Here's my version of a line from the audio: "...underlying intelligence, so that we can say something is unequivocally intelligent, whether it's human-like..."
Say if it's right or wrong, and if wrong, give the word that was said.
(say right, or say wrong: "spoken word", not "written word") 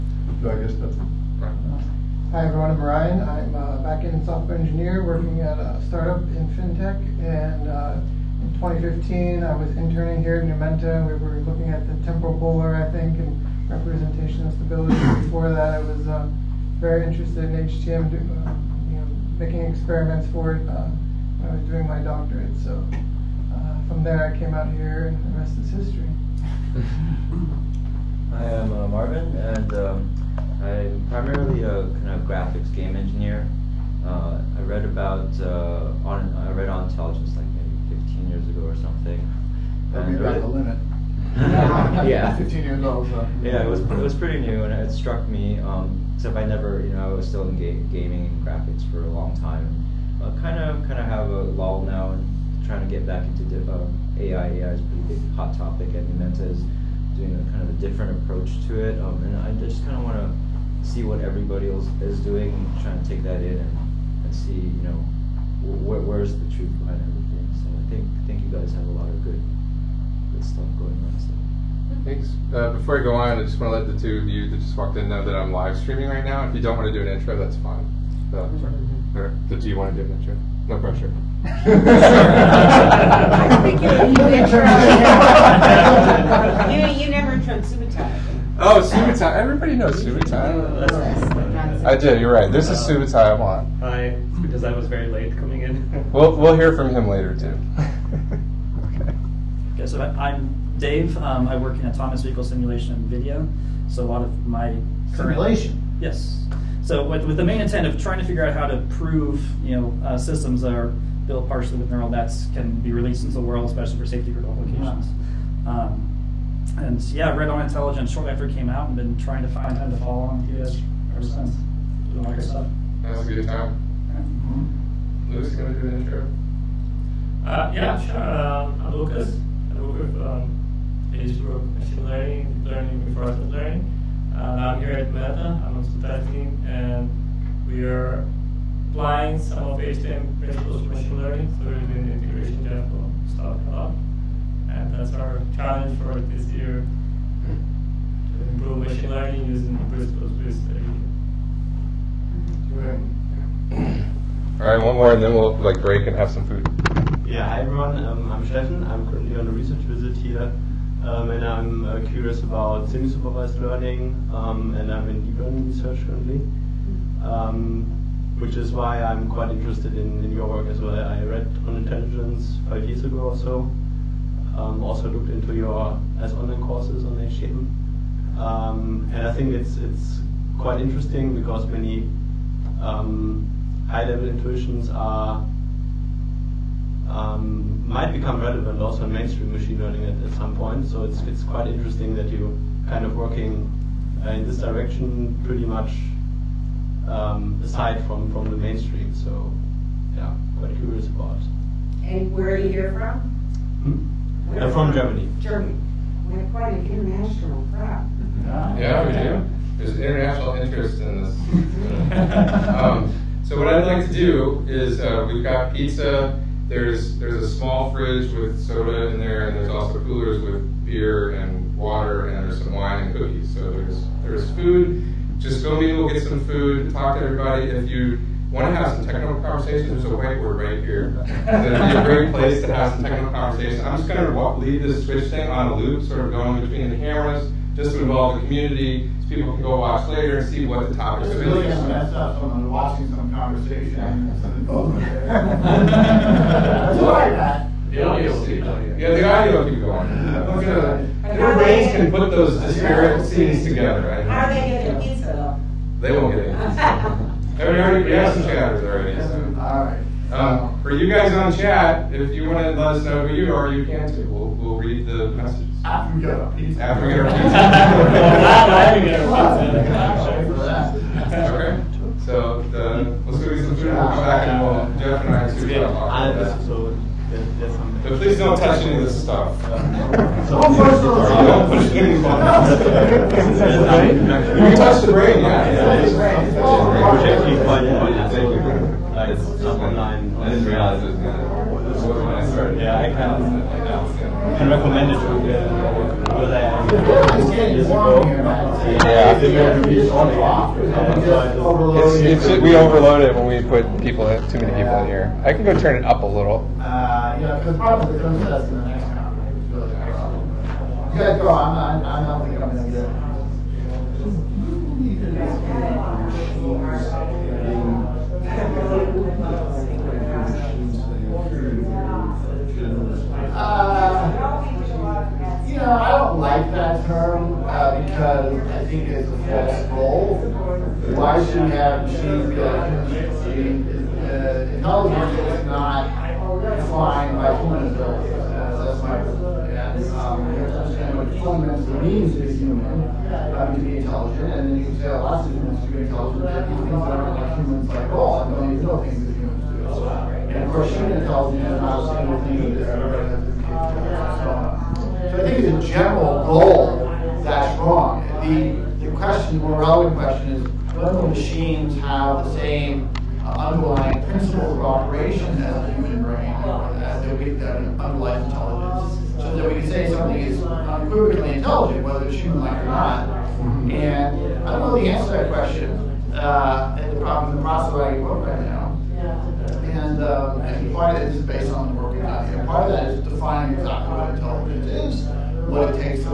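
right.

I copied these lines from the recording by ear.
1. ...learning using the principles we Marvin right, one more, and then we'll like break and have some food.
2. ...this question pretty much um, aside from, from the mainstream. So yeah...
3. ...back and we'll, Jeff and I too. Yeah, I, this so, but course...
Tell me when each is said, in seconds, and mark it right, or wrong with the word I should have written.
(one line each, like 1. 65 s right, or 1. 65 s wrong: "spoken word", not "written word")
1. 149 s wrong: "All", not "Marvin"
2. 194 s wrong: "direction", not "question"
3. 274 s wrong: "please", not "course".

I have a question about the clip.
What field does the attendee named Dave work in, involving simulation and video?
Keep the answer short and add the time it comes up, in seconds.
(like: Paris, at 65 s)
Autonomous vehicle simulation, at 101 s.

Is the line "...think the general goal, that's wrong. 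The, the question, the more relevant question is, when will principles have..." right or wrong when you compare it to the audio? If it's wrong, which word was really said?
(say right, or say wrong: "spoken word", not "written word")
wrong: "machines", not "principles".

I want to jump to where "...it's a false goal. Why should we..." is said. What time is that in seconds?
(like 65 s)
329 s.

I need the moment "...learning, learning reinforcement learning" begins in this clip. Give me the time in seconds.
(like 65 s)
132 s.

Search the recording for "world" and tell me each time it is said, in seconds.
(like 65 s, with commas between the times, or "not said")
113 s.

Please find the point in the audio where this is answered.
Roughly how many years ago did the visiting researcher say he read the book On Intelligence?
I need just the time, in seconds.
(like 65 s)
172 s.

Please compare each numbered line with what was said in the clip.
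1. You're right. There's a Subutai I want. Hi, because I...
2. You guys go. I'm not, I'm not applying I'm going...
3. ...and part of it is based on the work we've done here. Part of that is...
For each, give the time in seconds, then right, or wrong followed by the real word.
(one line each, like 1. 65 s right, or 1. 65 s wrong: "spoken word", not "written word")
1. 92 s right
2. 311 s wrong: "thinking", not "applying"
3. 380 s right.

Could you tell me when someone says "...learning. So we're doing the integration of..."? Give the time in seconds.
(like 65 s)
141 s.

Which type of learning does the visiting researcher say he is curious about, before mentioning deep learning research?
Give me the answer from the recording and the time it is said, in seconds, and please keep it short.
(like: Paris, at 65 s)
Semi-supervised learning, at 162 s.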